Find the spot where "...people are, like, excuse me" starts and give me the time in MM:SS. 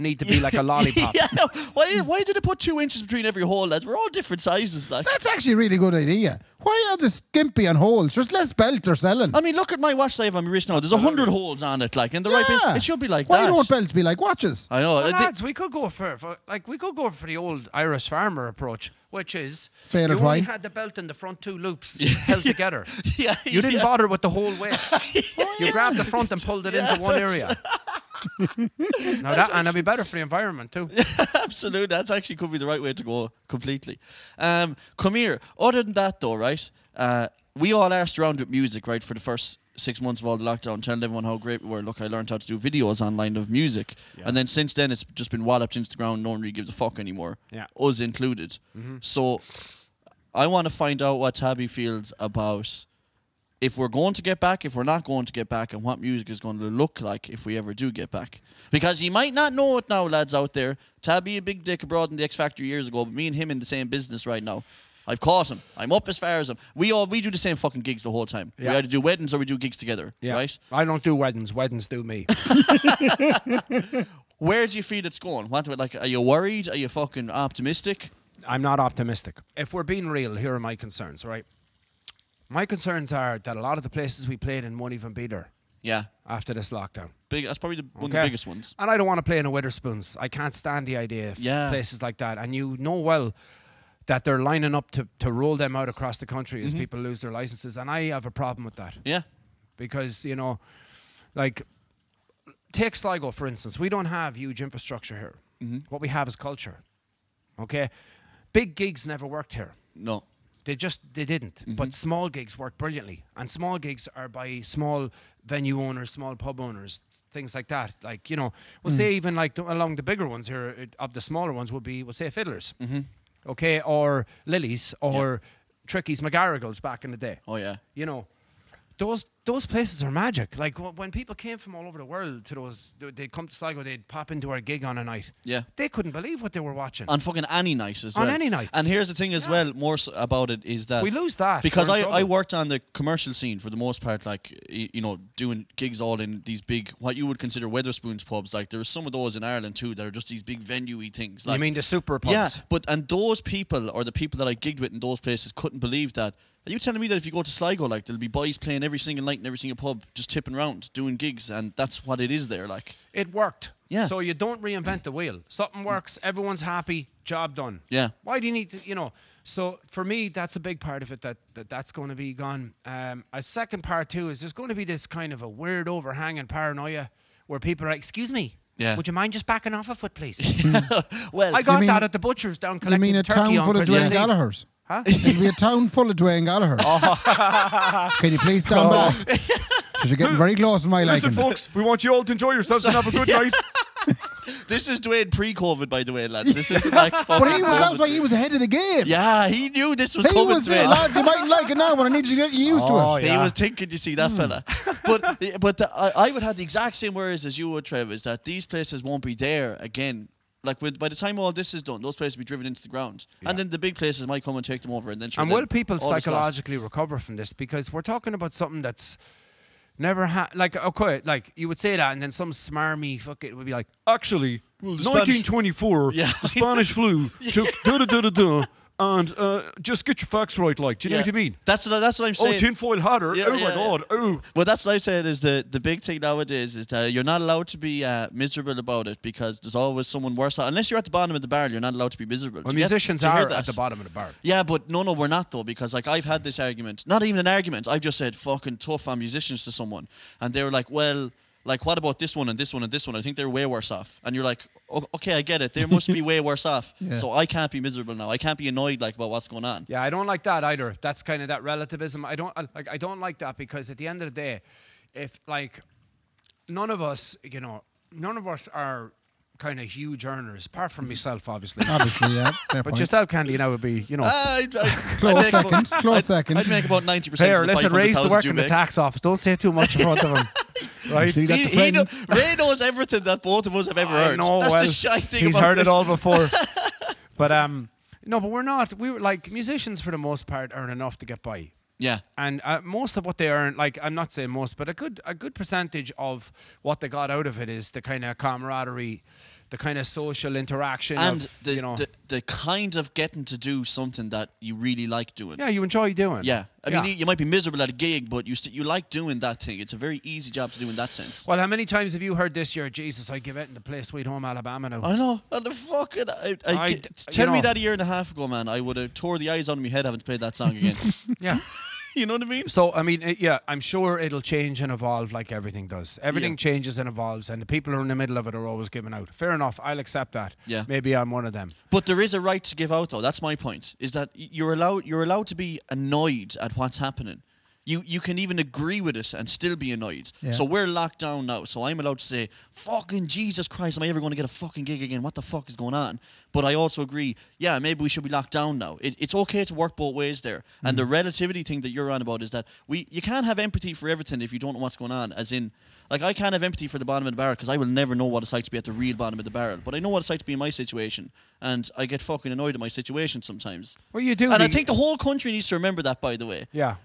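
02:57.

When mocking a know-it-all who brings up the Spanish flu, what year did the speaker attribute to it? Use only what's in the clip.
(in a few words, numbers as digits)
1924.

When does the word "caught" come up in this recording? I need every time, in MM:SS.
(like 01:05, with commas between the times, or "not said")
01:05.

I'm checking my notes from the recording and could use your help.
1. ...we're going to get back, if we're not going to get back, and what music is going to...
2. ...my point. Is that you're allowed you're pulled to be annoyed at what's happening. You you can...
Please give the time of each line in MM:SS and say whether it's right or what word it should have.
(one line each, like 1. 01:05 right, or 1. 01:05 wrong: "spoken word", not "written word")
1. 00:53 right
2. 05:33 wrong: "allowed", not "pulled".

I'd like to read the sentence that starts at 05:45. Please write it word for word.
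What the fuck is going on?" But I also agree, yeah, maybe we should be locked down now.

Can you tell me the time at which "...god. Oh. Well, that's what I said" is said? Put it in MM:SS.
03:53.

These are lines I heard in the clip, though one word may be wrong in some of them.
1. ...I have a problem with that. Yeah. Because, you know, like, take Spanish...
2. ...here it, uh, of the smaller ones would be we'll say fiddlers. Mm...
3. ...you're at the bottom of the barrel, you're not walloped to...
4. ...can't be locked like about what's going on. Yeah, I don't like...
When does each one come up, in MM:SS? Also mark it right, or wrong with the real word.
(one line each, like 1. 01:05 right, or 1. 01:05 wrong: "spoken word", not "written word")
1. 01:37 wrong: "Sligo", not "Spanish"
2. 02:00 right
3. 04:00 wrong: "allowed", not "walloped"
4. 04:18 wrong: "annoyed", not "locked".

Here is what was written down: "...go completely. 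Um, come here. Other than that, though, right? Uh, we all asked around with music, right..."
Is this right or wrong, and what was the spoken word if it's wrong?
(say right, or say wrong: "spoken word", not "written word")
right.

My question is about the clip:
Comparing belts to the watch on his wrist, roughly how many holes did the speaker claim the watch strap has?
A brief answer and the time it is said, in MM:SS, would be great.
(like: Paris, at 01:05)
100, at 00:10.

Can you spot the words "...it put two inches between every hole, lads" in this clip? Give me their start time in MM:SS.
00:02.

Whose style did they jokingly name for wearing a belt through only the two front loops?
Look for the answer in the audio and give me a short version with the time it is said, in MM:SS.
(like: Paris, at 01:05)
old Irish farmer, at 00:17.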